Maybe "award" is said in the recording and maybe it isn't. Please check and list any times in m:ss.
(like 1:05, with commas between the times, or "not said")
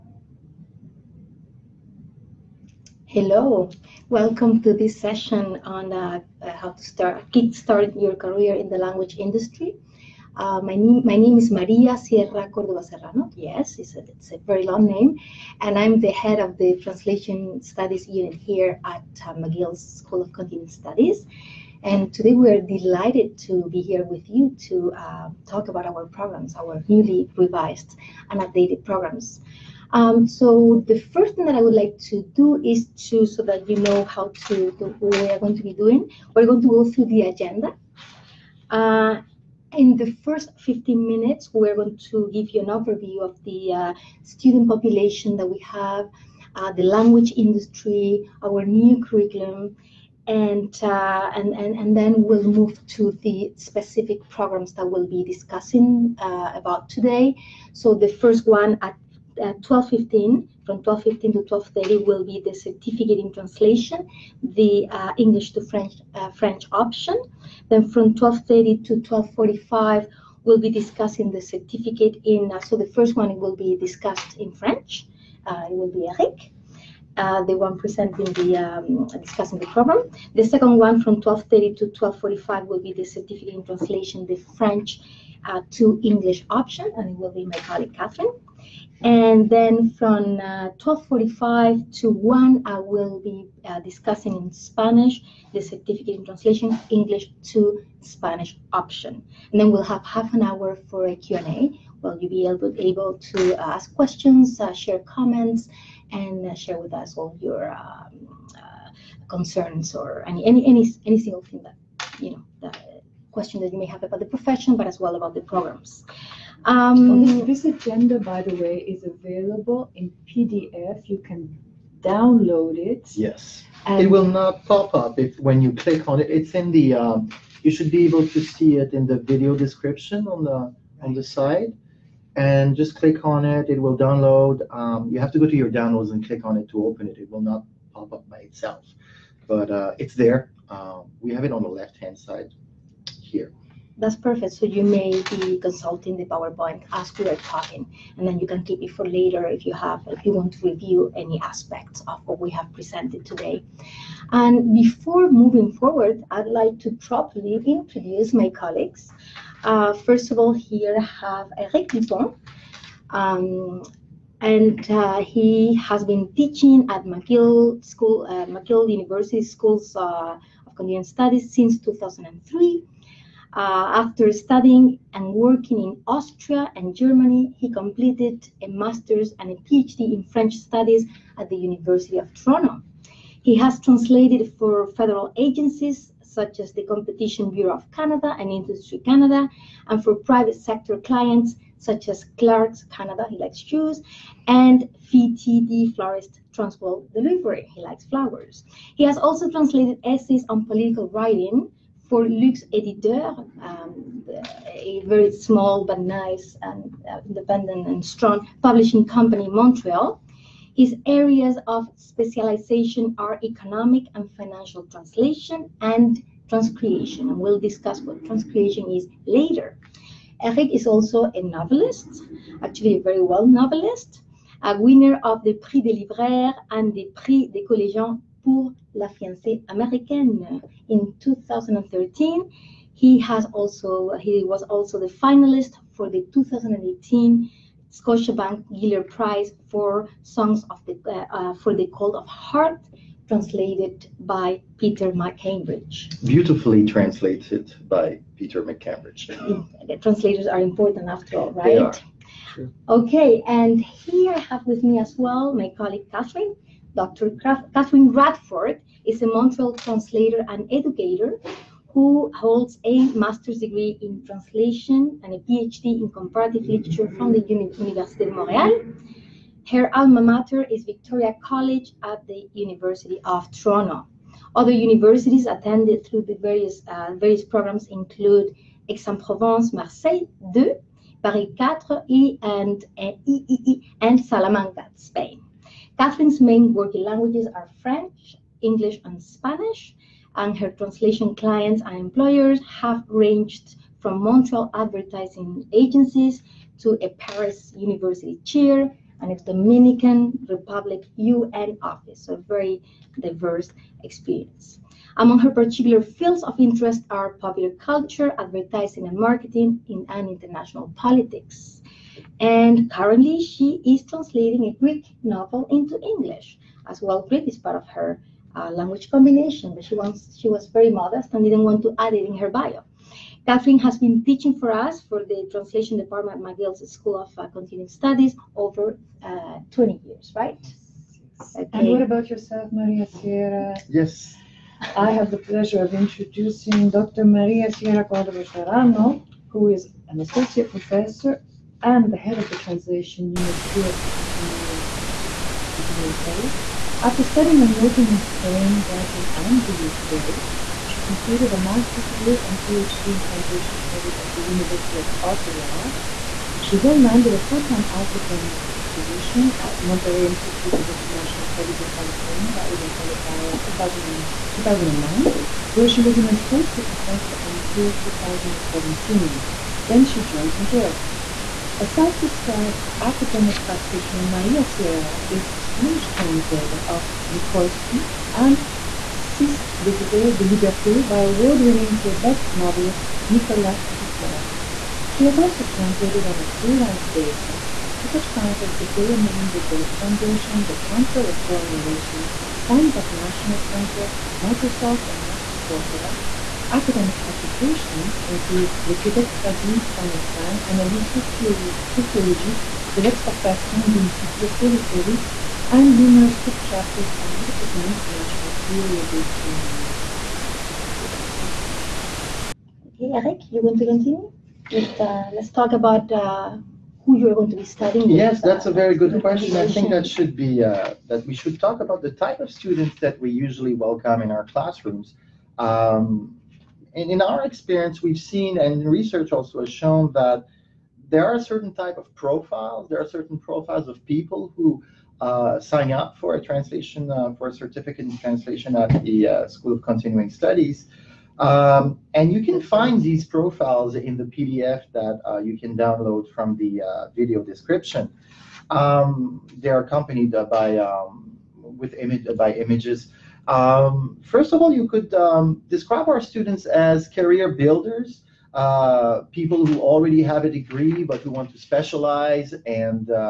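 6:21.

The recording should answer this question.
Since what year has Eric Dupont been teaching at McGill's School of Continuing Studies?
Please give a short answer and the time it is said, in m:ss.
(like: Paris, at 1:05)
2003, at 2:51.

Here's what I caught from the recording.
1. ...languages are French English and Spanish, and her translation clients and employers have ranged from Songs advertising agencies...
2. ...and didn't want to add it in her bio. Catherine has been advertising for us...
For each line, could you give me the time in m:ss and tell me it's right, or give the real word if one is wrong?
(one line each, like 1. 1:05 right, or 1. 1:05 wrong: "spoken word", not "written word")
1. 4:47 wrong: "Montreal", not "Songs"
2. 5:21 wrong: "teaching", not "advertising".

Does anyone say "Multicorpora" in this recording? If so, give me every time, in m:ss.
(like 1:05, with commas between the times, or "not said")
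6:35.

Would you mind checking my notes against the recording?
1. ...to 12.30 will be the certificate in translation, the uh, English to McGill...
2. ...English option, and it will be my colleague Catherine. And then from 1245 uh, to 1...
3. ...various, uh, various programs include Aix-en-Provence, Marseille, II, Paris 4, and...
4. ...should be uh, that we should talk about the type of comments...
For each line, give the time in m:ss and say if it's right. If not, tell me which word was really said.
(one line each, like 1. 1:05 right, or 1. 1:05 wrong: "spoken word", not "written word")
1. 1:01 wrong: "French", not "McGill"
2. 1:26 right
3. 4:36 right
4. 7:00 wrong: "students", not "comments".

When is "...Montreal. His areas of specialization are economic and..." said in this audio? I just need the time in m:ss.
3:29.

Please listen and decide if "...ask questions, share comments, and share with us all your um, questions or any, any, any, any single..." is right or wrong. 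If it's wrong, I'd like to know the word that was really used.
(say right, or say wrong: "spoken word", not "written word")
wrong: "concerns", not "questions".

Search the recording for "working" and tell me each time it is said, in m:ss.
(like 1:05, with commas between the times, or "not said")
2:55, 4:46, 5:47.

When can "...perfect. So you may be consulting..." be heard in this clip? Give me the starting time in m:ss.
2:24.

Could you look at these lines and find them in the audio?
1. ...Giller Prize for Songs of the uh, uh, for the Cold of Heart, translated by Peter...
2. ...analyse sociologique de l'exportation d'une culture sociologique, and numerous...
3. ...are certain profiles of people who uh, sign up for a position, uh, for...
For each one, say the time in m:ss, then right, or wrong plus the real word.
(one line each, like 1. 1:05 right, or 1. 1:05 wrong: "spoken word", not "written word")
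1. 3:58 right
2. 6:40 wrong: "périphérique", not "sociologique"
3. 7:12 wrong: "translation", not "position".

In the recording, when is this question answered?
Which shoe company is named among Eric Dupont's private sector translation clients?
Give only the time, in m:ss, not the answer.
3:12.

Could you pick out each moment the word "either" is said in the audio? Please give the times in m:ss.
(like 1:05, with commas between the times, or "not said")
not said.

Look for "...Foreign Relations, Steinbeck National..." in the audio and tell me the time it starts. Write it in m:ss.
6:31.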